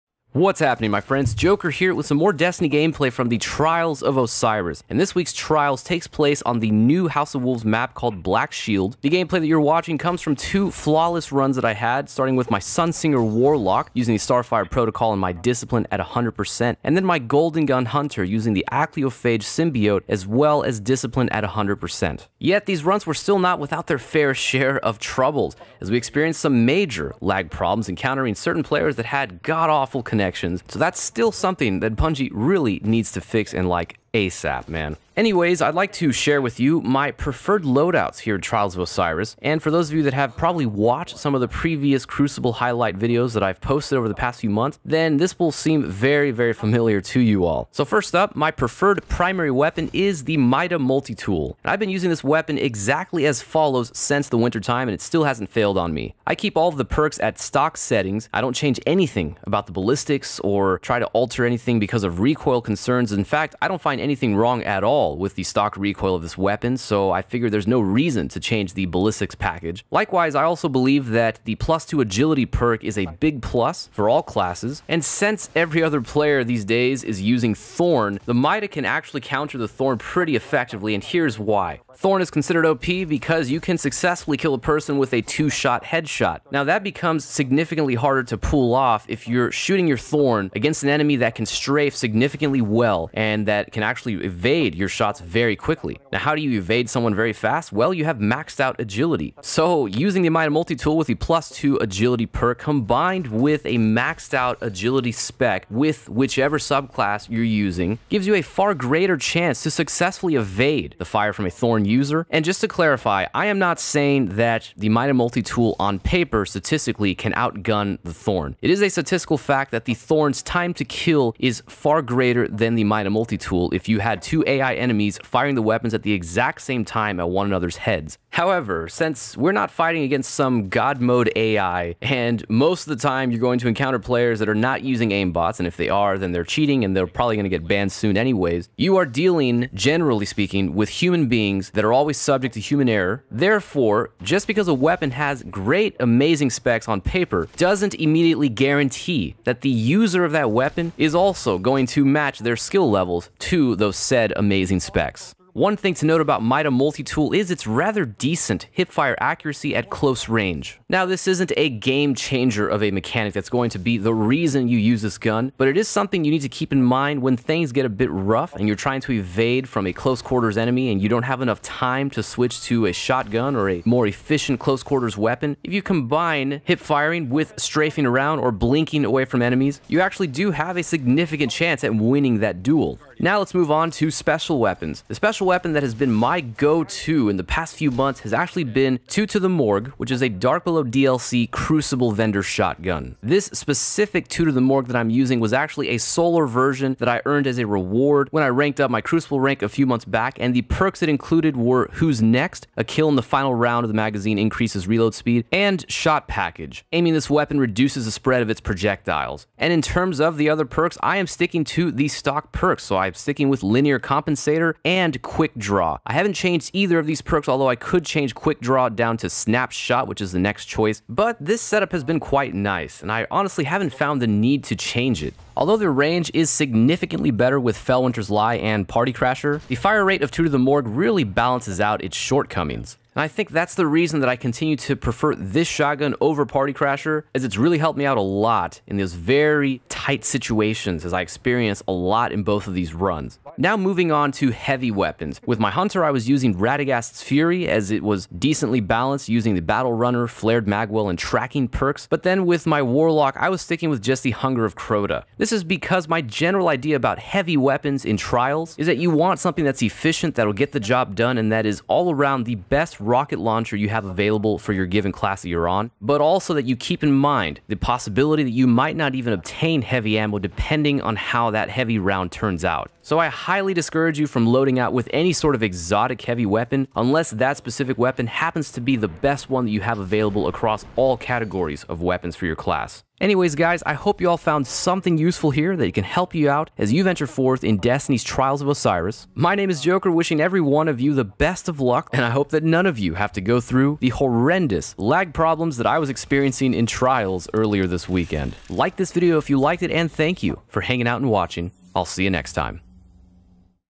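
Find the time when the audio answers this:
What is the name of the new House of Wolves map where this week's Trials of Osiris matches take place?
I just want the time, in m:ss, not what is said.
0:08.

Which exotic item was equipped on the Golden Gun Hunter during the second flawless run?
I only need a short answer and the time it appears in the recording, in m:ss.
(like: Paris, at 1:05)
Achlyophage Symbiote, at 0:18.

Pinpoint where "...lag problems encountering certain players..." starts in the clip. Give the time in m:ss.
0:27.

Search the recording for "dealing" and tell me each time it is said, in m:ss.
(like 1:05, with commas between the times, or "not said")
2:19.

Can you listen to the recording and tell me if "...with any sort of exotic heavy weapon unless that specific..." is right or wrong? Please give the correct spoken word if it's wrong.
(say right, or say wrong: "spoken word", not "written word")
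right.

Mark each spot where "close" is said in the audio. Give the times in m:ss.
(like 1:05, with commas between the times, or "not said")
2:39, 2:49, 2:54.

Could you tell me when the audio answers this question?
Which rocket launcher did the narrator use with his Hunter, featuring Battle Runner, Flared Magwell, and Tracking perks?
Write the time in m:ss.
4:06.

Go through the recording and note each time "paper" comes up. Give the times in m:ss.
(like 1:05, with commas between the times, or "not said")
1:55, 2:27.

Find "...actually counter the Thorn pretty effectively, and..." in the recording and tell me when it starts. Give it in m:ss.
1:18.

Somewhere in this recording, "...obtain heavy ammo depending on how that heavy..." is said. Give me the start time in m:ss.
4:29.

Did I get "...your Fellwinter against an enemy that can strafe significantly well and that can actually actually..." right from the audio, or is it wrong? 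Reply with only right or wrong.
wrong.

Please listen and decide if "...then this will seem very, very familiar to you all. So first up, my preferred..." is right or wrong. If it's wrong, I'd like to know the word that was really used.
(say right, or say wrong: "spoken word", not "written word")
right.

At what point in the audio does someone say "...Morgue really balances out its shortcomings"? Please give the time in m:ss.
3:50.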